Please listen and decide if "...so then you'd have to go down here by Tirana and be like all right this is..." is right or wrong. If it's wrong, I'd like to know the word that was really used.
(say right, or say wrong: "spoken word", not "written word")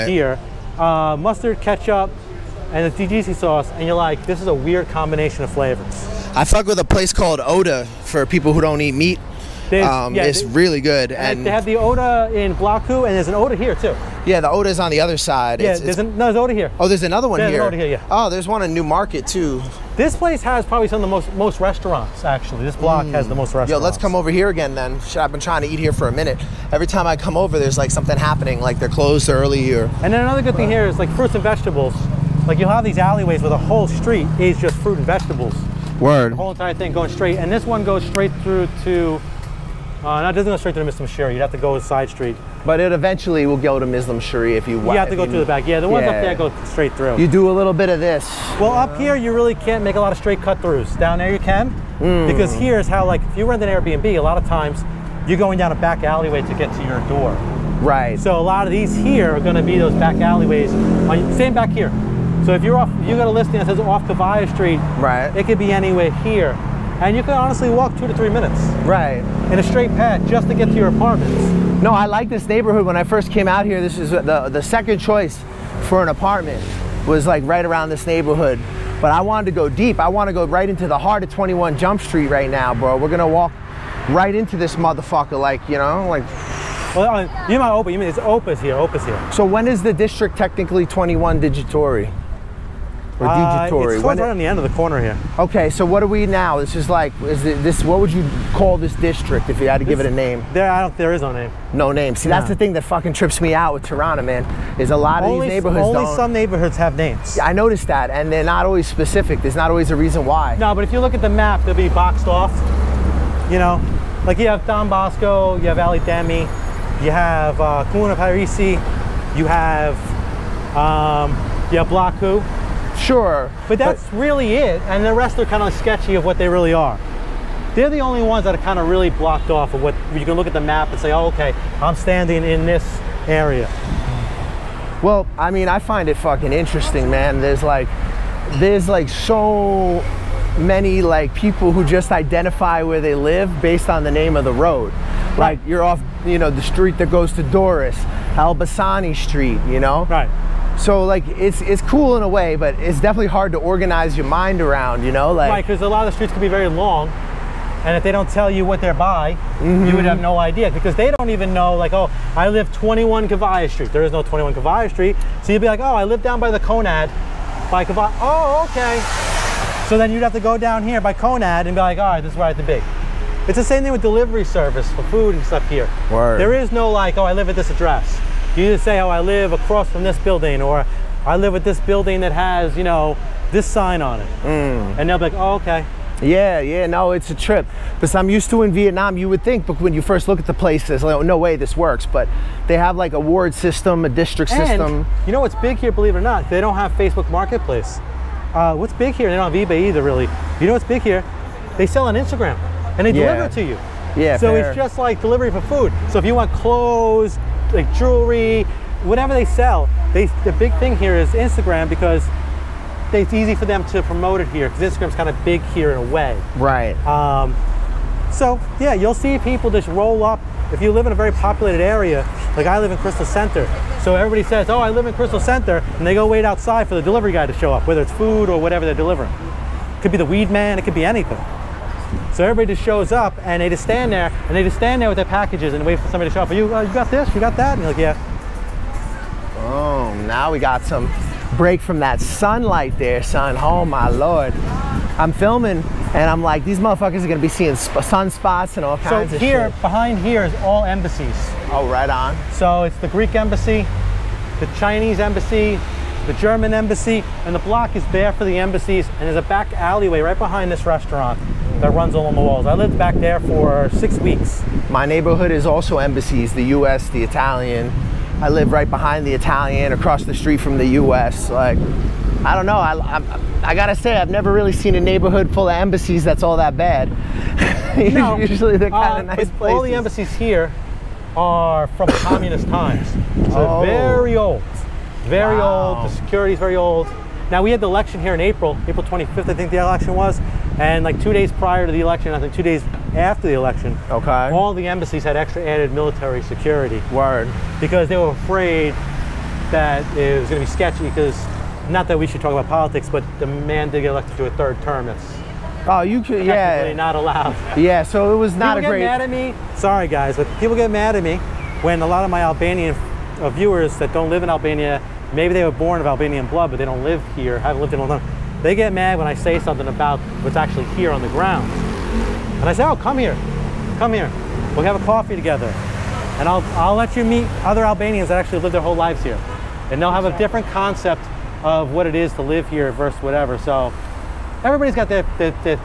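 wrong: "Conad", not "Tirana".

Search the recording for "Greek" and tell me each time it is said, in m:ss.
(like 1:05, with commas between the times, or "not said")
4:13.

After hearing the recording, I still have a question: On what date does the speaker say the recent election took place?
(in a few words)
April 25.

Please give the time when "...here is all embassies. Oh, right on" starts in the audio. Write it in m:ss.
4:10.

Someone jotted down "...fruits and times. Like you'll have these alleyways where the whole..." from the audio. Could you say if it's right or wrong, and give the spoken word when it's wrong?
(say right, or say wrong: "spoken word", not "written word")
wrong: "vegetables", not "times".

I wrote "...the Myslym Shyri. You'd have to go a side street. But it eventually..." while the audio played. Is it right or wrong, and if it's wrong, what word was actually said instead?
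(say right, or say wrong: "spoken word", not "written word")
right.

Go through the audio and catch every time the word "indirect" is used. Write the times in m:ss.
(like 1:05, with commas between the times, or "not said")
not said.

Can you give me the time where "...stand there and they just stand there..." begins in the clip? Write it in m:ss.
3:53.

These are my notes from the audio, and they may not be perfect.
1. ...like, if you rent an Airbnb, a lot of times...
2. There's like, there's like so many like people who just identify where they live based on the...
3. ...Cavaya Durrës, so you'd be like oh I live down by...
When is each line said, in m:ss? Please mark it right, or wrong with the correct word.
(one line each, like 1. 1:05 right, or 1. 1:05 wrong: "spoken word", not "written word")
1. 0:53 right
2. 2:17 right
3. 2:44 wrong: "Street", not "Durrës".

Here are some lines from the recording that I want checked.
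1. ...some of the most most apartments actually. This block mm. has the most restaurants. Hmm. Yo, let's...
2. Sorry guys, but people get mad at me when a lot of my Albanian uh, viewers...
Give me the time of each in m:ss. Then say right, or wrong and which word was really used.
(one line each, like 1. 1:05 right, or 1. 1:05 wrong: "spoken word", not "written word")
1. 0:20 wrong: "restaurants", not "apartments"
2. 5:09 right.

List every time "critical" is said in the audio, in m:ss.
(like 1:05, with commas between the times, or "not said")
not said.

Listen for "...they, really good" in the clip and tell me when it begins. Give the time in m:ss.
0:10.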